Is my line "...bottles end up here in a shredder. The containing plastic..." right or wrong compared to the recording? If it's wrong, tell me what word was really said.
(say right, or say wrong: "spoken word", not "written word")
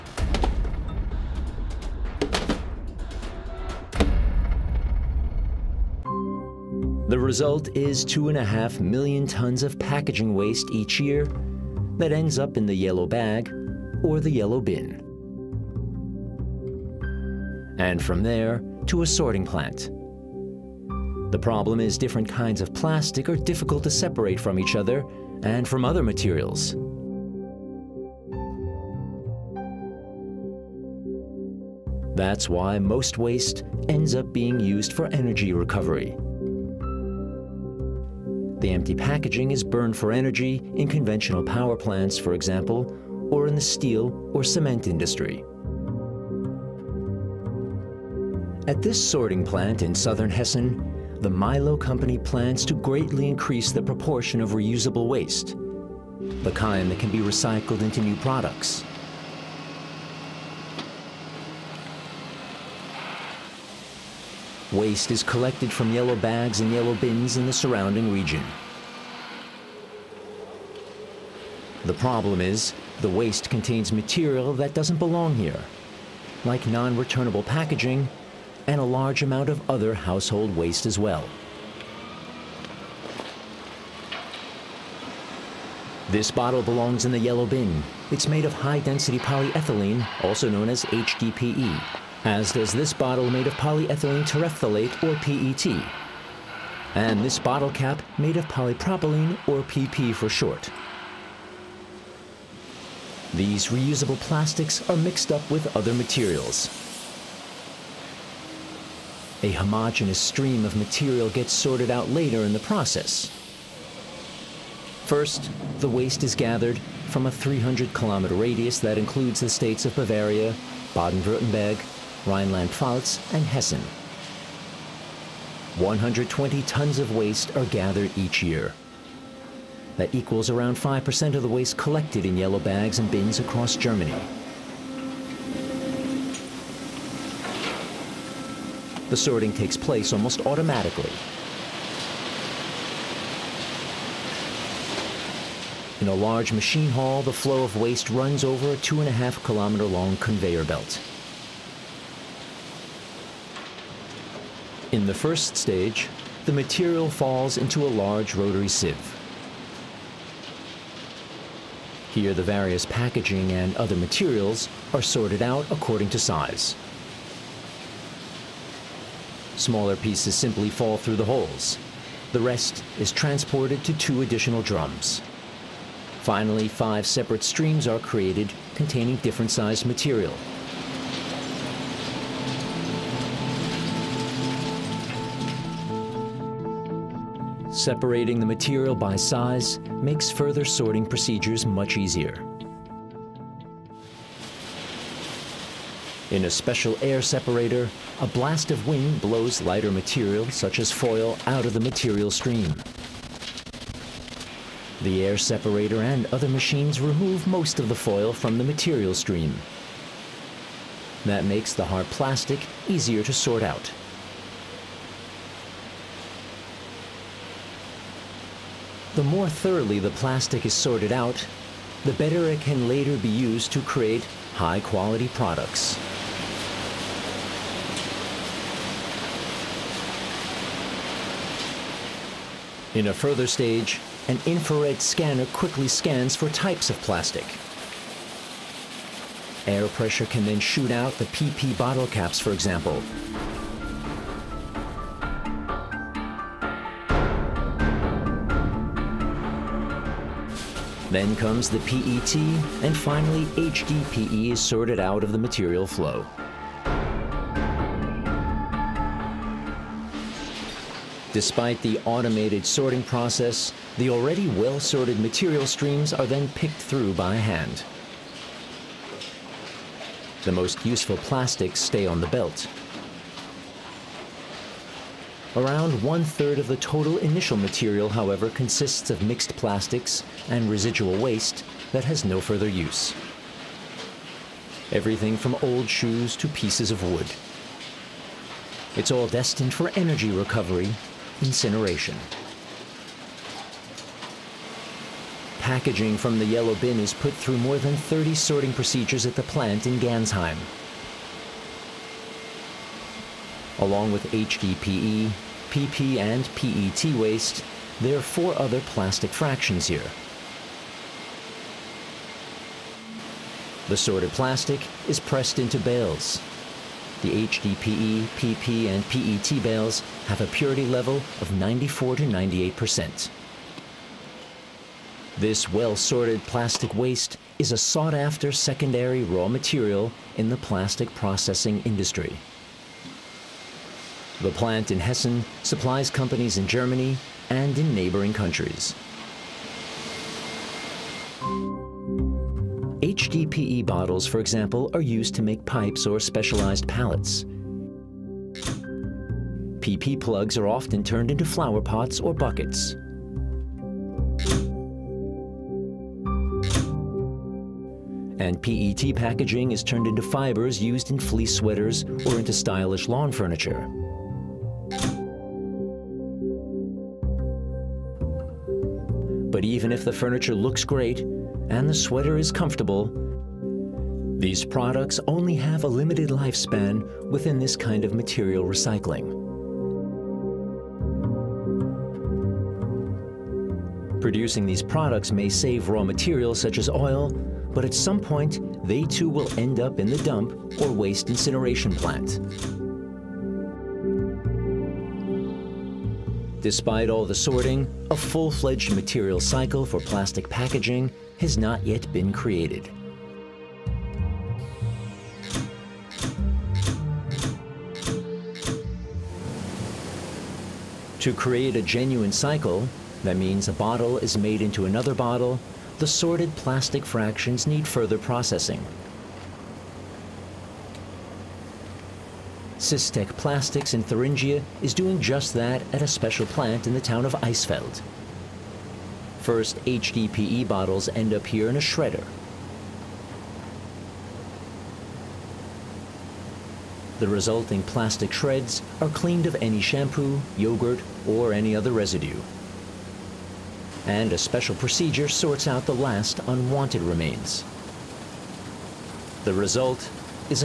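wrong: "resulting", not "containing".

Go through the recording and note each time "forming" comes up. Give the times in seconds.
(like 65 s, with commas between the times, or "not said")
not said.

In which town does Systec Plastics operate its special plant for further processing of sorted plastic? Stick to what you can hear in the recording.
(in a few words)
Eisfeld.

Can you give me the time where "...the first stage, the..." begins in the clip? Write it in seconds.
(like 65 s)
155 s.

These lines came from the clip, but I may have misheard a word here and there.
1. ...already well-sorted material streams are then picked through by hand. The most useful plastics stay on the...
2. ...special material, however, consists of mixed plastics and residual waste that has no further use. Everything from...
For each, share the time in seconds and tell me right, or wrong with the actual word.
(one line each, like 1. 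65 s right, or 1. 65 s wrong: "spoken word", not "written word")
1. 264 s right
2. 277 s wrong: "initial", not "special".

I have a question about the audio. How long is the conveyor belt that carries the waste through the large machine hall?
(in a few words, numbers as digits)
2.5 kilometers.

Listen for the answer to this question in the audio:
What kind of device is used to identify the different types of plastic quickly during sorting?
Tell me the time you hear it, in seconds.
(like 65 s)
234 s.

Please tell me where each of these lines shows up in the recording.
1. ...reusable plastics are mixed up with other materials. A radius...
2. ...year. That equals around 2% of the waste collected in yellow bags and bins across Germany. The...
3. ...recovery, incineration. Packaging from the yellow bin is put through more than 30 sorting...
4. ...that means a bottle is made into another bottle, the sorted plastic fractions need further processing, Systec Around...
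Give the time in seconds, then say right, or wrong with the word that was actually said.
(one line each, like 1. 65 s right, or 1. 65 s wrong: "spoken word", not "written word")
1. 103 s wrong: "homogeneous", not "radius"
2. 128 s wrong: "5", not "2"
3. 290 s right
4. 413 s wrong: "Plastics", not "Around".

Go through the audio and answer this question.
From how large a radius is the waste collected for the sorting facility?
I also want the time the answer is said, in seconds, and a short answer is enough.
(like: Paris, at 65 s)
300 kilometers, at 117 s.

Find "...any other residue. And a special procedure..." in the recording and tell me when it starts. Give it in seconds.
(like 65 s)
441 s.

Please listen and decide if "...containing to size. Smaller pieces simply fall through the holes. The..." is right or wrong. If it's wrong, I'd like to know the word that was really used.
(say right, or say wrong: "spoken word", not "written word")
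wrong: "according", not "containing".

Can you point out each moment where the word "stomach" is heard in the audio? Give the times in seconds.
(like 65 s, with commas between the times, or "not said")
not said.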